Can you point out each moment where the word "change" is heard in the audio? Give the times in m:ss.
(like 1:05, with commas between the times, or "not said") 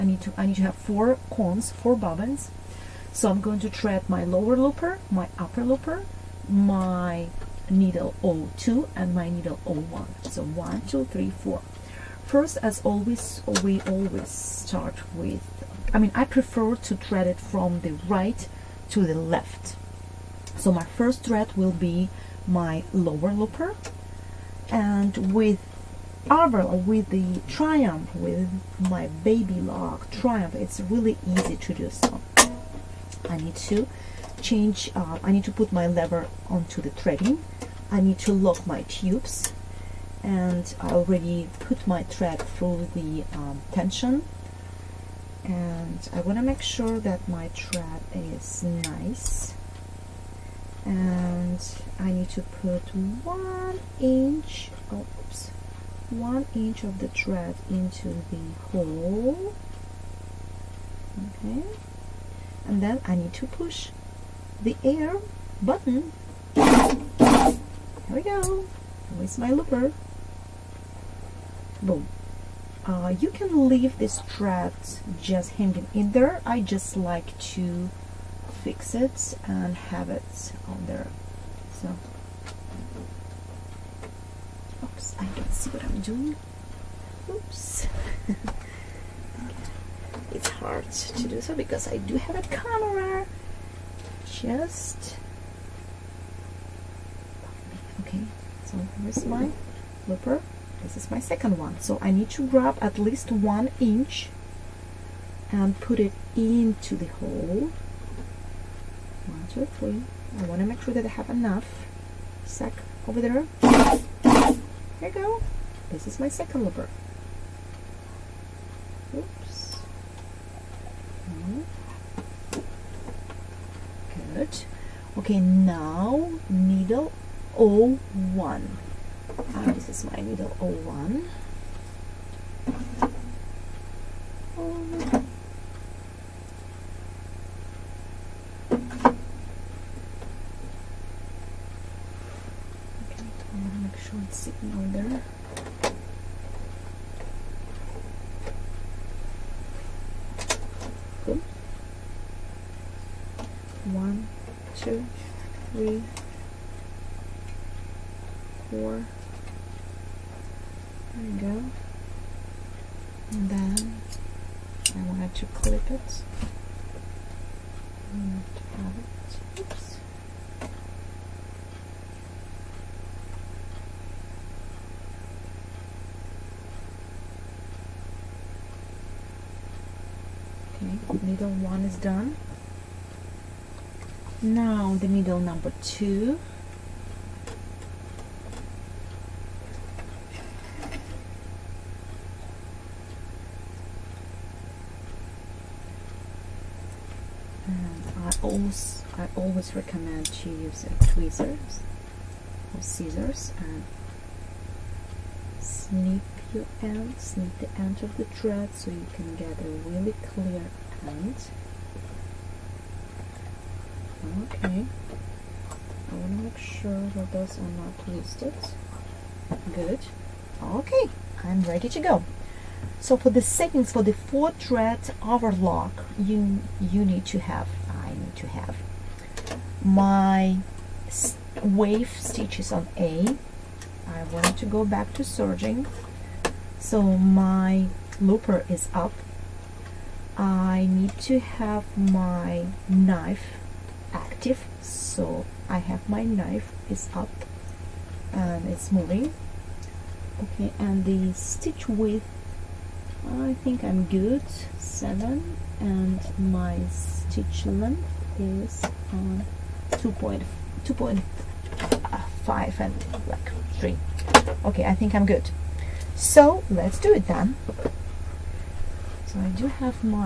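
0:34.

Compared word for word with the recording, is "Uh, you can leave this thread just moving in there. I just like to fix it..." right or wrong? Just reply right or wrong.
wrong.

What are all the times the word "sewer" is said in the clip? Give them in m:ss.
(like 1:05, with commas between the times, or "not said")
not said.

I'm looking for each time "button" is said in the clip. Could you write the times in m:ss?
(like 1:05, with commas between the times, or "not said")
1:05.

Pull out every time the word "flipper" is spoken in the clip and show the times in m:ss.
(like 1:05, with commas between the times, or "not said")
1:40, 1:56.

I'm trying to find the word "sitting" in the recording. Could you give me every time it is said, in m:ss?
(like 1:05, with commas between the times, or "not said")
2:24.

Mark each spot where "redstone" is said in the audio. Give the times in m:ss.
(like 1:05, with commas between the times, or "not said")
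not said.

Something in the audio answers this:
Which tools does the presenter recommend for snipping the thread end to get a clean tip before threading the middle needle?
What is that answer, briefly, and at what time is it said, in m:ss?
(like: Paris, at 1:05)
tweezers or scissors, at 3:21.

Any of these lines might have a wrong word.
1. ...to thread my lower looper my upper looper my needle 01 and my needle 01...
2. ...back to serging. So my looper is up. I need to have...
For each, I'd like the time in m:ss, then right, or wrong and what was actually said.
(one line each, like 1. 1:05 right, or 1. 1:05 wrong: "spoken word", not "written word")
1. 0:03 wrong: "02", not "01"
2. 3:54 right.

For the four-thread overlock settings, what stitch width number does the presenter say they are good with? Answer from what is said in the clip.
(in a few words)
7.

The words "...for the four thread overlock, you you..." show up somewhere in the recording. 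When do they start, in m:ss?
3:43.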